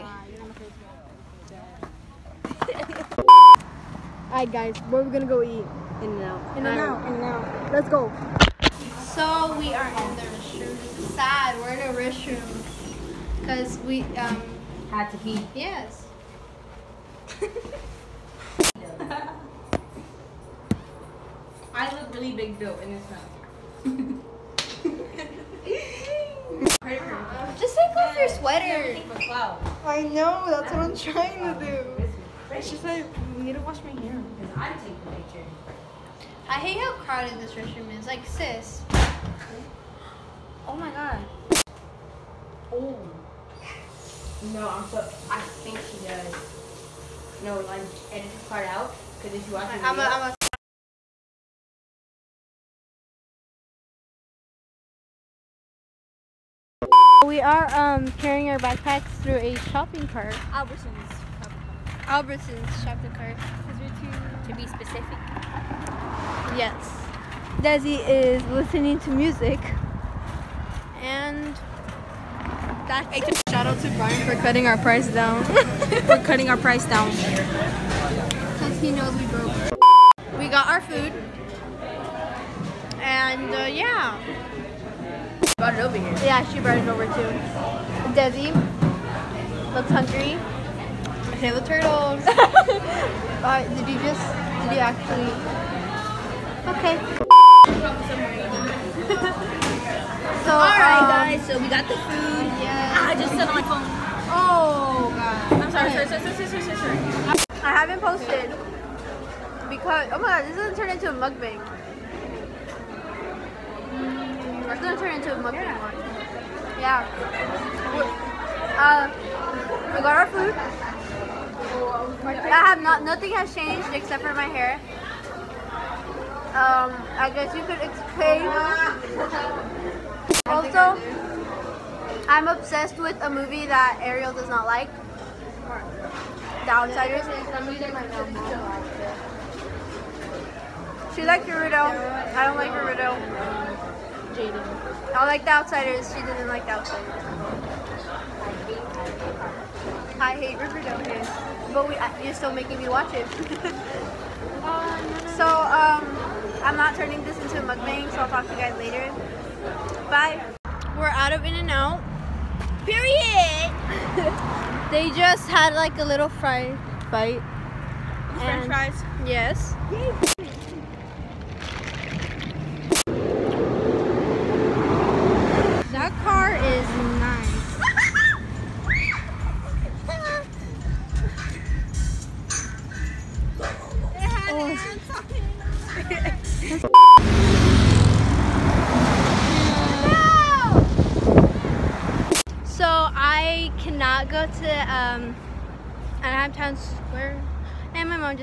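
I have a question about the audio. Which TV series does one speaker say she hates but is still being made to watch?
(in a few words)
Riverdale.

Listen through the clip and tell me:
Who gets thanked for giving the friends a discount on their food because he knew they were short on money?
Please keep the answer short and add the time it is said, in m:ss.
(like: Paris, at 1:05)
Brian, at 1:13.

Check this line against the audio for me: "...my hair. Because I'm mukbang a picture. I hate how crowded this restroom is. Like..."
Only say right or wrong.
wrong.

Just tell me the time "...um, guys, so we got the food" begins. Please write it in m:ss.
1:41.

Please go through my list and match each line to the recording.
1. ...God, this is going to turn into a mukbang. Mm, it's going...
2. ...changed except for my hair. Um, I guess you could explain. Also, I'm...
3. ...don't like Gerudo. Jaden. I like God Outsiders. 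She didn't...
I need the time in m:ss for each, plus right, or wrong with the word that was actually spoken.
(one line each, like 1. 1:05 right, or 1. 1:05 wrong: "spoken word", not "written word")
1. 1:50 right
2. 2:03 right
3. 2:22 wrong: "The", not "God".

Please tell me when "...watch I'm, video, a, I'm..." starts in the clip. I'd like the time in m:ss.
0:49.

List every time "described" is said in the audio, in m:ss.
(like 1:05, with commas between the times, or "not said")
not said.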